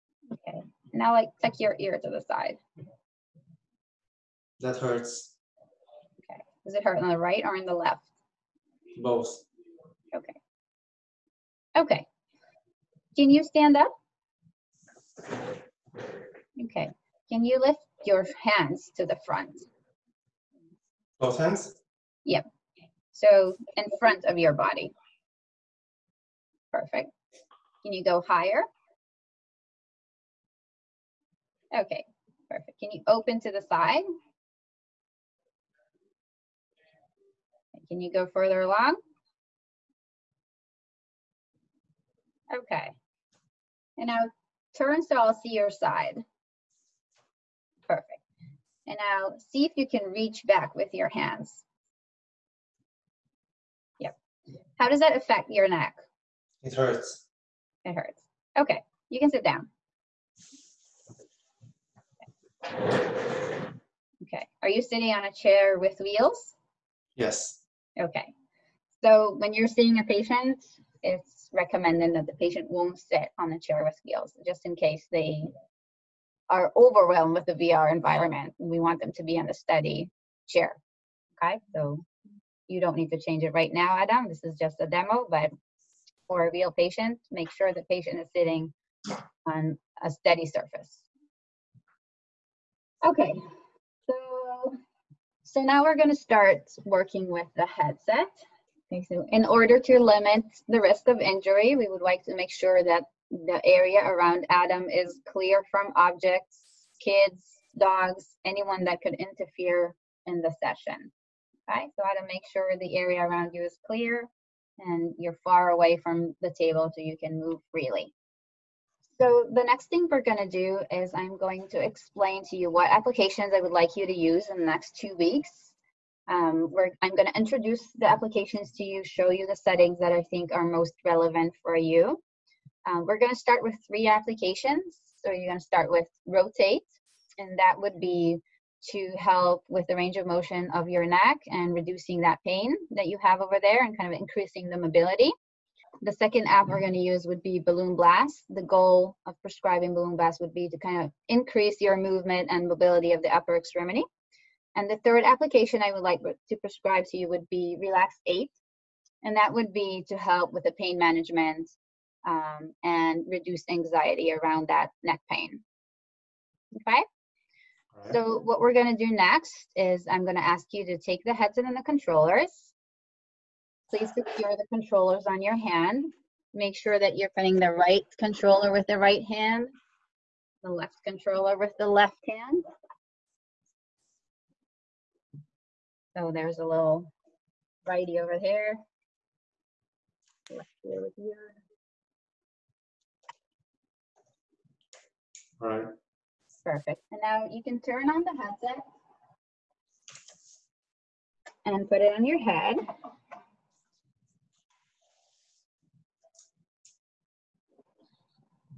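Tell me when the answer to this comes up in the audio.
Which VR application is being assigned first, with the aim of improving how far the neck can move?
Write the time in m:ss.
2:16.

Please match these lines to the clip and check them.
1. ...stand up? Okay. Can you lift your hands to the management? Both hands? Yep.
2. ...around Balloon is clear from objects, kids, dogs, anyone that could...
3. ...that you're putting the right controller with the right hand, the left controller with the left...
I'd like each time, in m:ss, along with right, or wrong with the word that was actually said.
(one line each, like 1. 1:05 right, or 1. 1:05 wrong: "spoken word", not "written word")
1. 0:13 wrong: "front", not "management"
2. 1:44 wrong: "Adam", not "Balloon"
3. 2:56 right.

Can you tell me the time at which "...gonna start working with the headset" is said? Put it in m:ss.
1:35.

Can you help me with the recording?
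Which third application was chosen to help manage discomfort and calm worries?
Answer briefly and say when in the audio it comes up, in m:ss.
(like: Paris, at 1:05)
Relax 8, at 2:37.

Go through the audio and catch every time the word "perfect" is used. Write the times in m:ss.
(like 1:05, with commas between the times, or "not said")
0:26, 0:32, 0:47, 3:16.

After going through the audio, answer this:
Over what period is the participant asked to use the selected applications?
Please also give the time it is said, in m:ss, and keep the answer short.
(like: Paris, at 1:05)
2 weeks, at 2:04.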